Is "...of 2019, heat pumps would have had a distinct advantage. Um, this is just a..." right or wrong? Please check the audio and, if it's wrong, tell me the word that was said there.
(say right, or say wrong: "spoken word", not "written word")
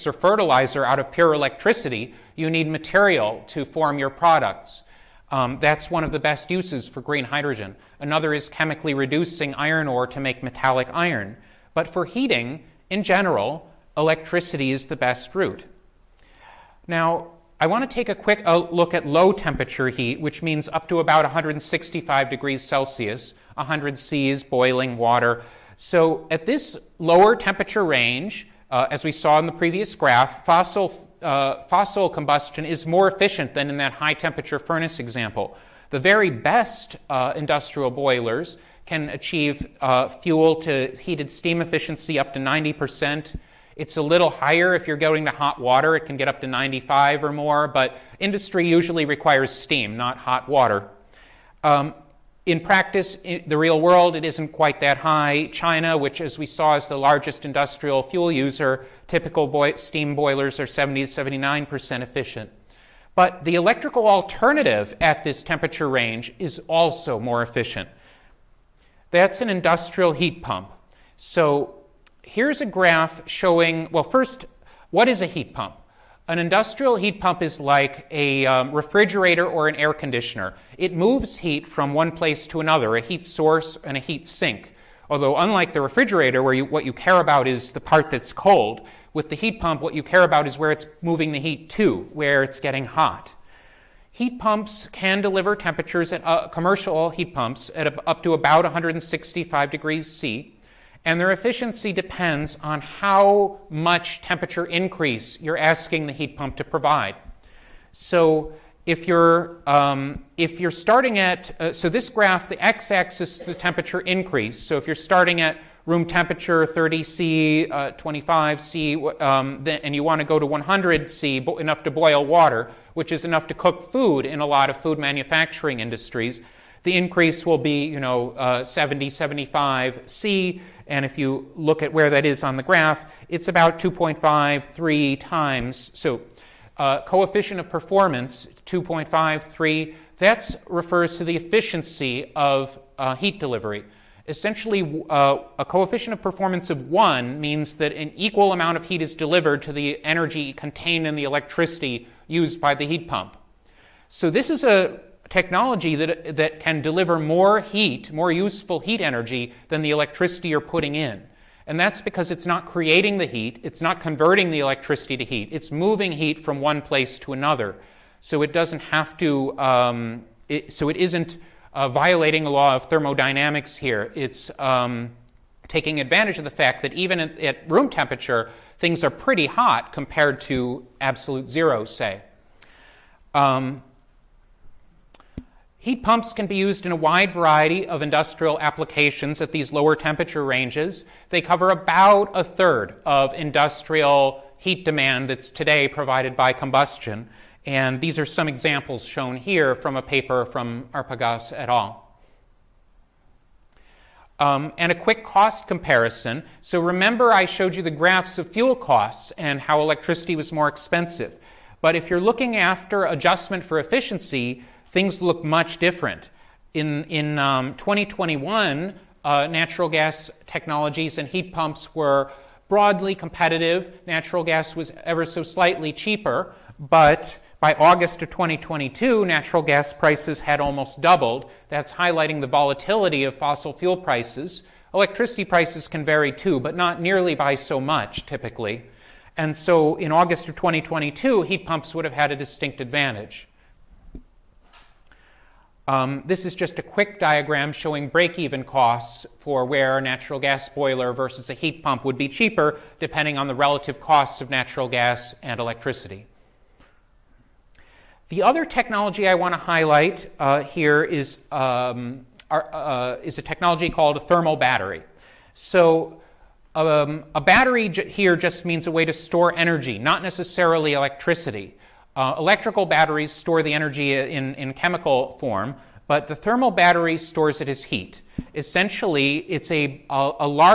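wrong: "2022", not "2019".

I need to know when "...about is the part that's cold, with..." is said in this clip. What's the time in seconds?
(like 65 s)
87 s.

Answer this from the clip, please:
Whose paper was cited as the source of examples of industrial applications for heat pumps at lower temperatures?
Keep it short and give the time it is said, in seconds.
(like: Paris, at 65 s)
Arpagaus et al., at 200 s.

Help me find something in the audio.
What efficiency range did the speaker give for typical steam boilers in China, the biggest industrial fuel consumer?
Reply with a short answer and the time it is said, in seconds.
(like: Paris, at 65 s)
70 to 79%, at 60 s.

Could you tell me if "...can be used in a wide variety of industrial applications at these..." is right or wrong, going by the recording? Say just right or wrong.
right.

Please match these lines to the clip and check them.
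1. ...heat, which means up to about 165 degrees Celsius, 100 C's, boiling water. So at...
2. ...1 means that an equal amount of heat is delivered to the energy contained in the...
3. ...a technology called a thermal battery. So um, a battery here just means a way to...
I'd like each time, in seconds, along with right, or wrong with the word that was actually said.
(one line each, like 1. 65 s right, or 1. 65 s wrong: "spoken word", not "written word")
1. 19 s right
2. 146 s right
3. 263 s right.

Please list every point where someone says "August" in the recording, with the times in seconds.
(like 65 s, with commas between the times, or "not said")
227 s, 240 s.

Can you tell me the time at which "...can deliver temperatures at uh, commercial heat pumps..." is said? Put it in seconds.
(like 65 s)
94 s.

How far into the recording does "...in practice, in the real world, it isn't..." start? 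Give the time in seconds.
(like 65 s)
52 s.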